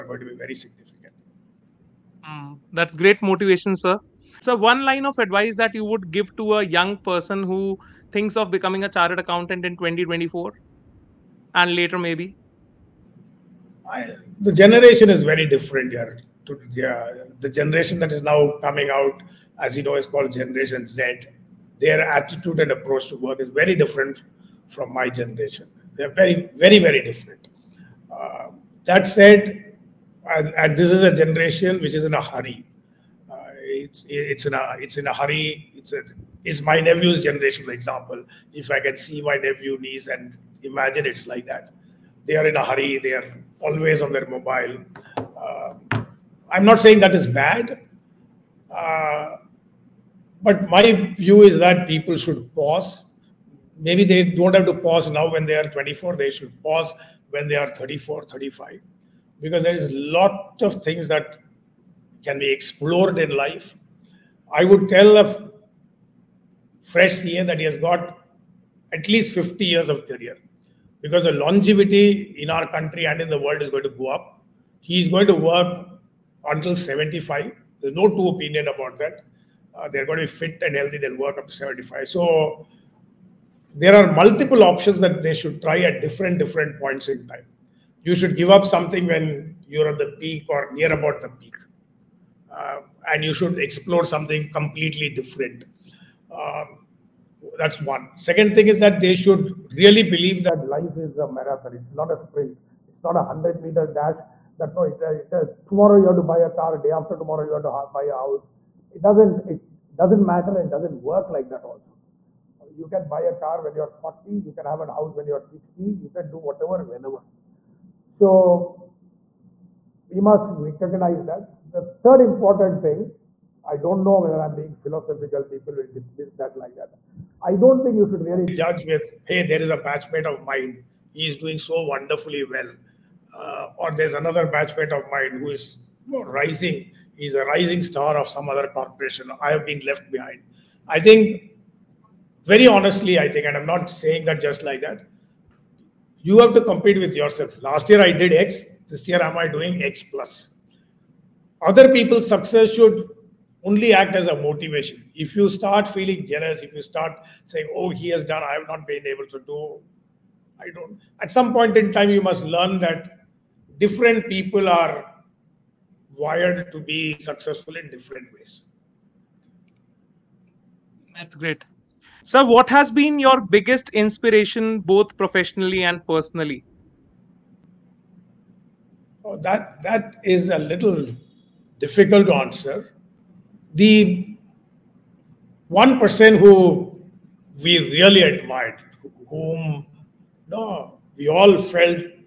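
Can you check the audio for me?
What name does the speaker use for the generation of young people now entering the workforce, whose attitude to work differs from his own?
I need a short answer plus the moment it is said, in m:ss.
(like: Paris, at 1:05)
Generation Z, at 0:20.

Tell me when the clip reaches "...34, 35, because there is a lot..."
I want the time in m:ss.
0:57.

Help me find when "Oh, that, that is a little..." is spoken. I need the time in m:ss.
2:59.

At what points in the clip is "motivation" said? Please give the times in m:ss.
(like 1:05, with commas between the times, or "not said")
0:03, 2:34.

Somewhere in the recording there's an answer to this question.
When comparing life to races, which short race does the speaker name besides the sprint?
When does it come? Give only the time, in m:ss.
1:43.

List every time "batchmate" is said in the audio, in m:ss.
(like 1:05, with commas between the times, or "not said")
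2:09, 2:14.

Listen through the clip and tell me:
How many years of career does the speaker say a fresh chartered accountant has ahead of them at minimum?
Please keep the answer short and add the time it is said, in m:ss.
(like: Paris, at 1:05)
50, at 1:09.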